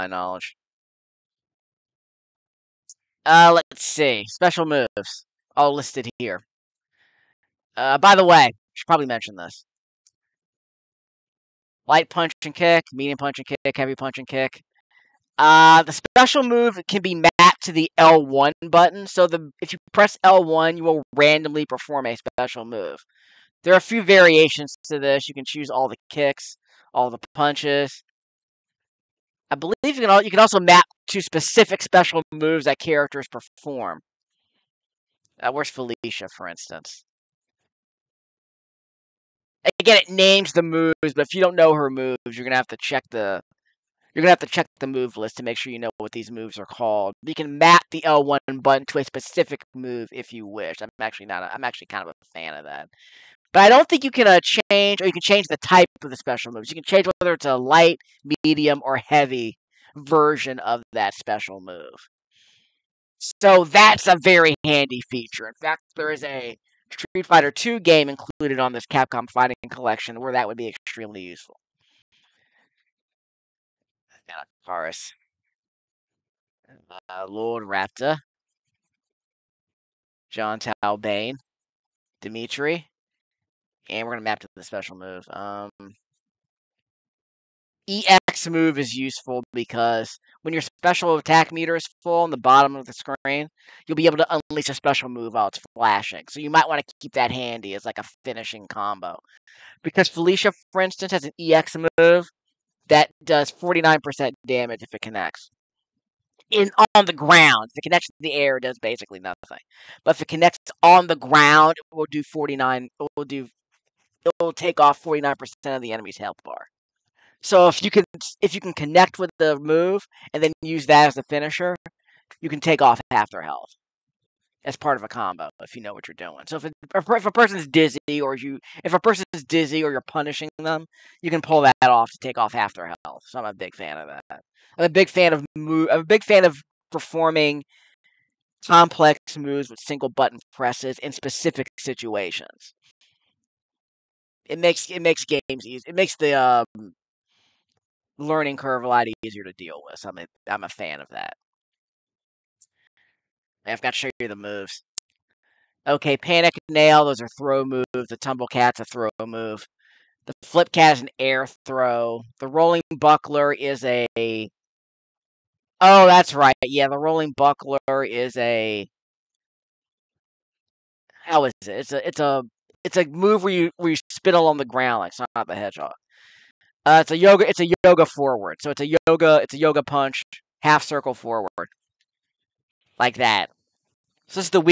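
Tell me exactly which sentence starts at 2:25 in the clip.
It makes the um, learning curve a lot easier to deal with.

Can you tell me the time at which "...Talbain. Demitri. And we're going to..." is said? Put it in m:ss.
1:20.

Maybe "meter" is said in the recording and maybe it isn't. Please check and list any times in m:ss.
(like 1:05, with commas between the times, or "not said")
1:31.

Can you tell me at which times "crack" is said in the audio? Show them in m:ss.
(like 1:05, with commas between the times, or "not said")
not said.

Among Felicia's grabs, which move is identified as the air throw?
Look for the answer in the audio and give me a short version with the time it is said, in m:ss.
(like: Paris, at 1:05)
Flip cat, at 2:40.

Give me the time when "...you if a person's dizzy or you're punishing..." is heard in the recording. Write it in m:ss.
2:08.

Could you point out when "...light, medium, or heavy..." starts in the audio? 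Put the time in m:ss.
0:57.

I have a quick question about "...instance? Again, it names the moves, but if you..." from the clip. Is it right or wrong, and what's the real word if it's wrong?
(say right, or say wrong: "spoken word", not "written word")
right.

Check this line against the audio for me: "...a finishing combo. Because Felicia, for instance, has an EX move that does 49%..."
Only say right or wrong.
right.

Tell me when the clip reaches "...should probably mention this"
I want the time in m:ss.
0:08.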